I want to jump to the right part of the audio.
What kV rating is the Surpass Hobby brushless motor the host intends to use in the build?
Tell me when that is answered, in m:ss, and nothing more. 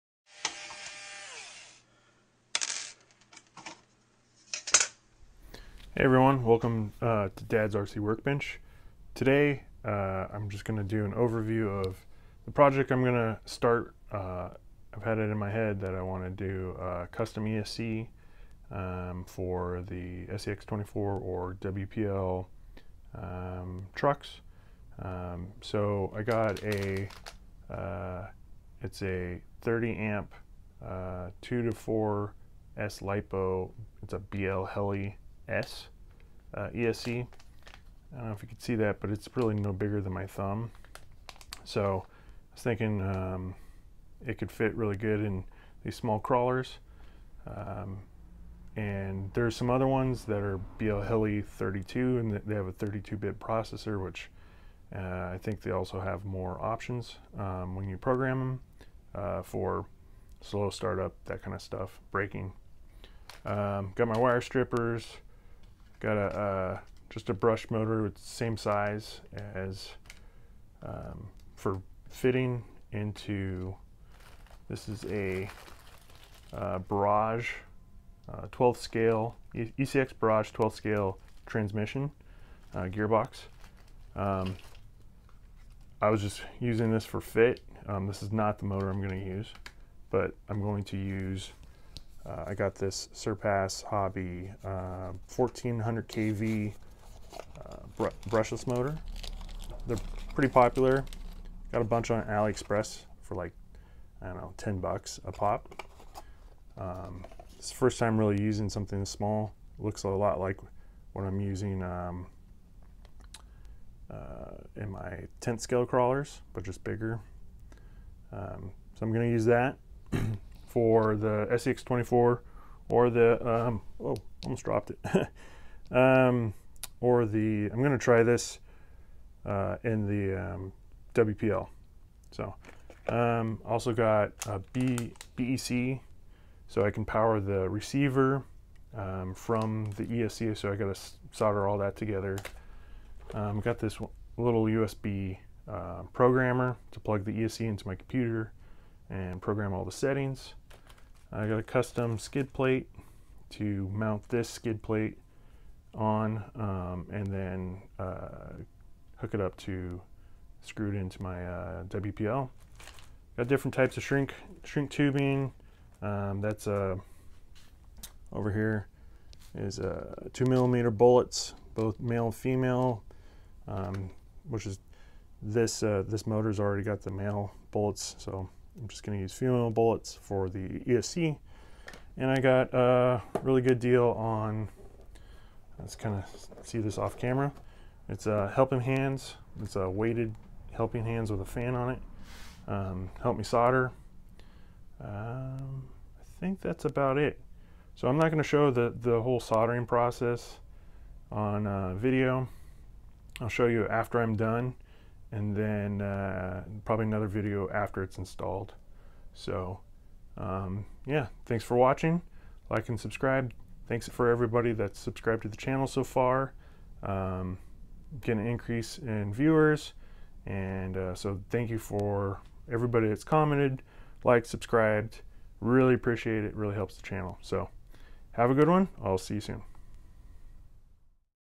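1:35.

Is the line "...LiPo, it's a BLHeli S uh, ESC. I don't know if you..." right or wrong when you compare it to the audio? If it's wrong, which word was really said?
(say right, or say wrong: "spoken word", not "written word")
right.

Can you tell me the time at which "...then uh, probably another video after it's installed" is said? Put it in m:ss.
3:25.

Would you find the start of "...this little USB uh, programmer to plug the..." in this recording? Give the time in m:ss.
2:23.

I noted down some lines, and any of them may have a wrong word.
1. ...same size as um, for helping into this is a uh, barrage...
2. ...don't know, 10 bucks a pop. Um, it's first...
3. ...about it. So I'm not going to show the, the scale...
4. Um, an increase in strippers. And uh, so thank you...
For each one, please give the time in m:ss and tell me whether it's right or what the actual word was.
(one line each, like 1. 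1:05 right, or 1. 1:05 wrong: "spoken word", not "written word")
1. 1:08 wrong: "fitting", not "helping"
2. 1:44 right
3. 3:16 wrong: "whole", not "scale"
4. 3:37 wrong: "viewers", not "strippers".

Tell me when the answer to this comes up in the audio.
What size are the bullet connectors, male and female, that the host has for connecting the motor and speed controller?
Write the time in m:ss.
2:50.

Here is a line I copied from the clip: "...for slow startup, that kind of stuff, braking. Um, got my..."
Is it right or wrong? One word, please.
right.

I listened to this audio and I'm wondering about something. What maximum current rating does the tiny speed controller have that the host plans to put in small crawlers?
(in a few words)
30 amp.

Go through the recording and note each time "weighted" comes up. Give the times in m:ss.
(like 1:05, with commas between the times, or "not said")
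3:09.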